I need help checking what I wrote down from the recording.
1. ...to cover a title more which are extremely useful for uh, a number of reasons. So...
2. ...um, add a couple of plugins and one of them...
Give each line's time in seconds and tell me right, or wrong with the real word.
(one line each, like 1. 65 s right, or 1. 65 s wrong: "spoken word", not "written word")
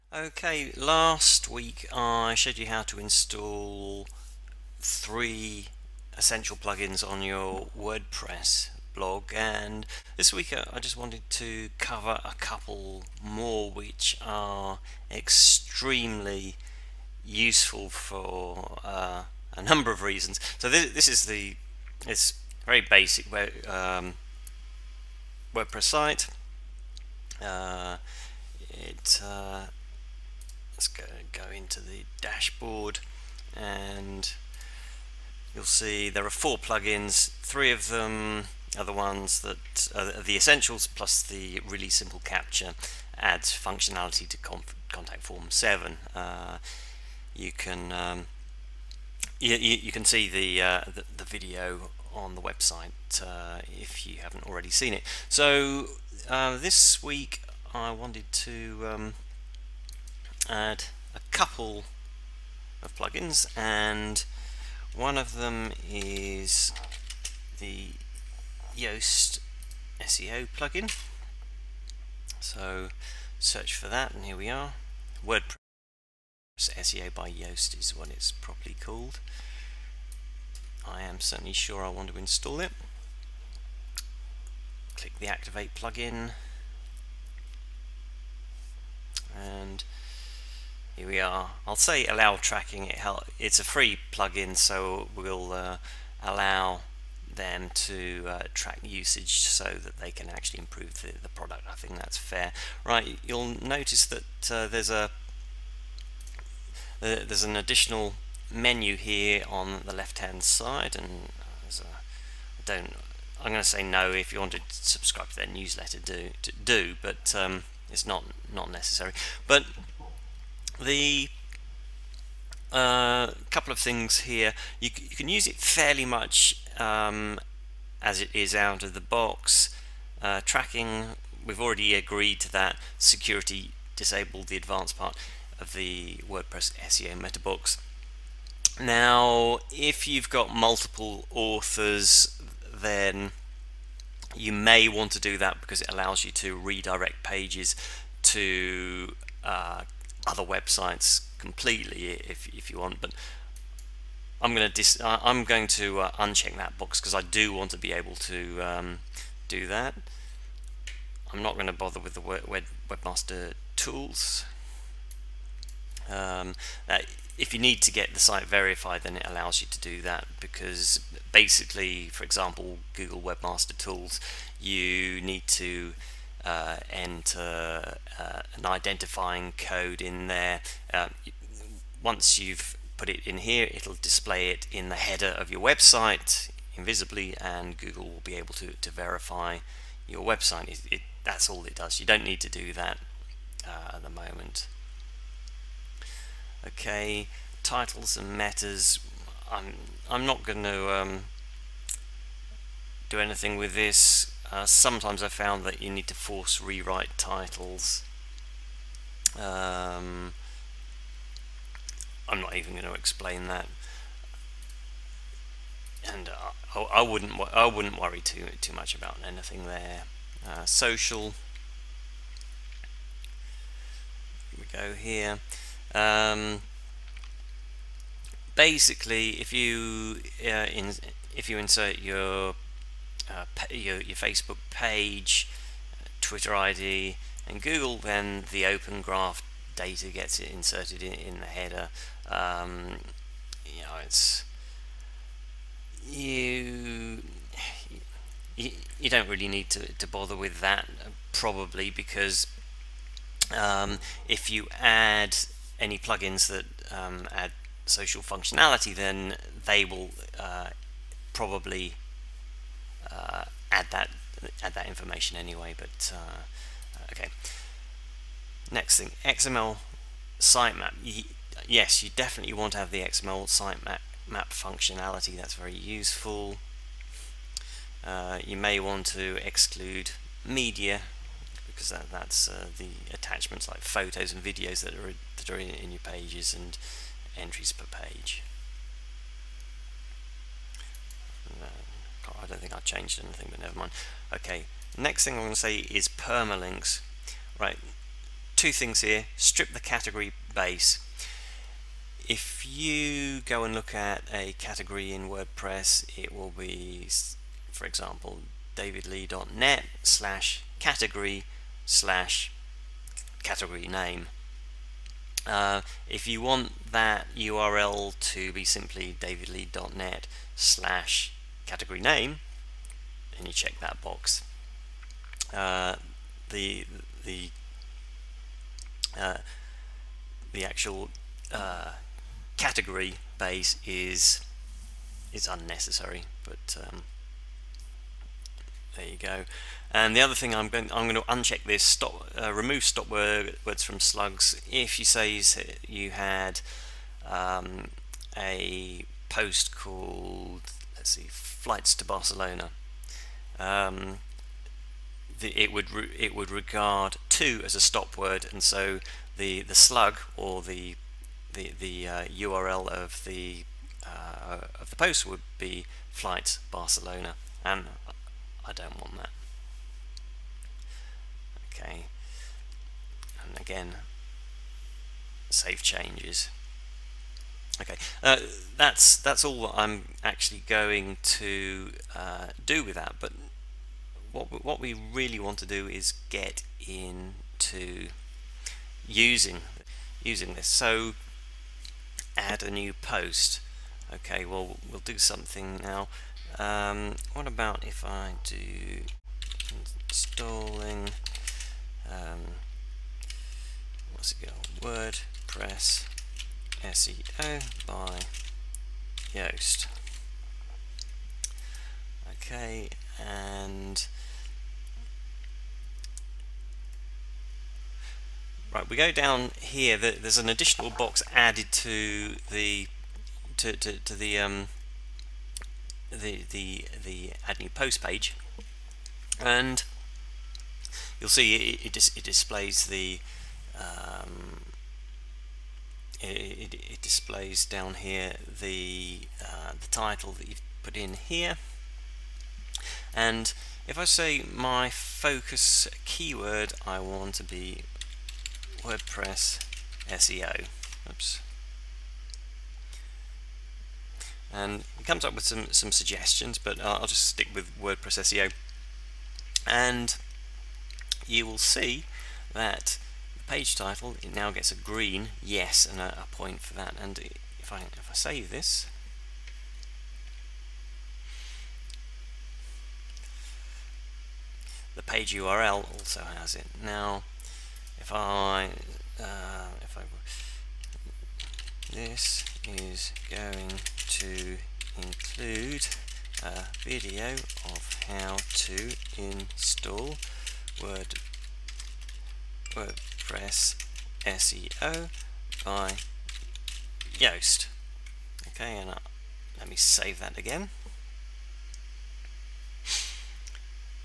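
1. 11 s wrong: "couple", not "title"
2. 58 s right.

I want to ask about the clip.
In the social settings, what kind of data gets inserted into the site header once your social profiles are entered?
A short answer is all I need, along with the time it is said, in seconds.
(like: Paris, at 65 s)
Open Graph data, at 238 s.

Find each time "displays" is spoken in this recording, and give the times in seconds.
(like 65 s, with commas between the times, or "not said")
183 s, 432 s, 437 s.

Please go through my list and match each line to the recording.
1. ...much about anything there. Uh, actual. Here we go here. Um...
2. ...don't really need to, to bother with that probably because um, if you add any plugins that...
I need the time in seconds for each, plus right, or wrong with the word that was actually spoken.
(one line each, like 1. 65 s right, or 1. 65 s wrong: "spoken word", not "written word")
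1. 218 s wrong: "social", not "actual"
2. 249 s right.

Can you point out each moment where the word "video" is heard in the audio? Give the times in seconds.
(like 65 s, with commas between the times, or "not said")
51 s, 284 s, 486 s.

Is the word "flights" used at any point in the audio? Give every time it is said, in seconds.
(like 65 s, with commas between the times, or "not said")
351 s, 366 s.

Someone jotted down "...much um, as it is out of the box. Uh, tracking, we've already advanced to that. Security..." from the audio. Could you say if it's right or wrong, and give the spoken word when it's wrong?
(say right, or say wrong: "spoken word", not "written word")
wrong: "agreed", not "advanced".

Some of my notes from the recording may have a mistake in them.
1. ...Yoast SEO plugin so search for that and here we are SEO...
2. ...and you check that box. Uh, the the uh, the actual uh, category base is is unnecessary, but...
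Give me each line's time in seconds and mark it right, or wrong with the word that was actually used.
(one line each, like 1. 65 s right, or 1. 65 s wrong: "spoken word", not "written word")
1. 68 s wrong: "WordPress", not "SEO"
2. 323 s right.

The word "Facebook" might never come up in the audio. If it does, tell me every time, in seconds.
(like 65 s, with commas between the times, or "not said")
234 s.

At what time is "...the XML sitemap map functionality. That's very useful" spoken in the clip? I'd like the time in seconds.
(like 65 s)
272 s.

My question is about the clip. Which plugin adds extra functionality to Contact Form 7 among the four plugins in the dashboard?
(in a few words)
Really Simple CAPTCHA.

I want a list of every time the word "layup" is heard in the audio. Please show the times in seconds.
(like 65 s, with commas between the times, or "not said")
not said.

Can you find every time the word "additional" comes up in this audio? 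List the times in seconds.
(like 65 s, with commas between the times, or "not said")
107 s, 420 s.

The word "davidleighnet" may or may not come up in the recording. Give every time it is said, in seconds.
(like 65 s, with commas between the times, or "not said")
308 s, 319 s.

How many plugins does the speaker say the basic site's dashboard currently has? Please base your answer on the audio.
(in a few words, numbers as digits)
4.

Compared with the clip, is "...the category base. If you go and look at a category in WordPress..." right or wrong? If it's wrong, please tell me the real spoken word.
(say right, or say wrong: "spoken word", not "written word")
right.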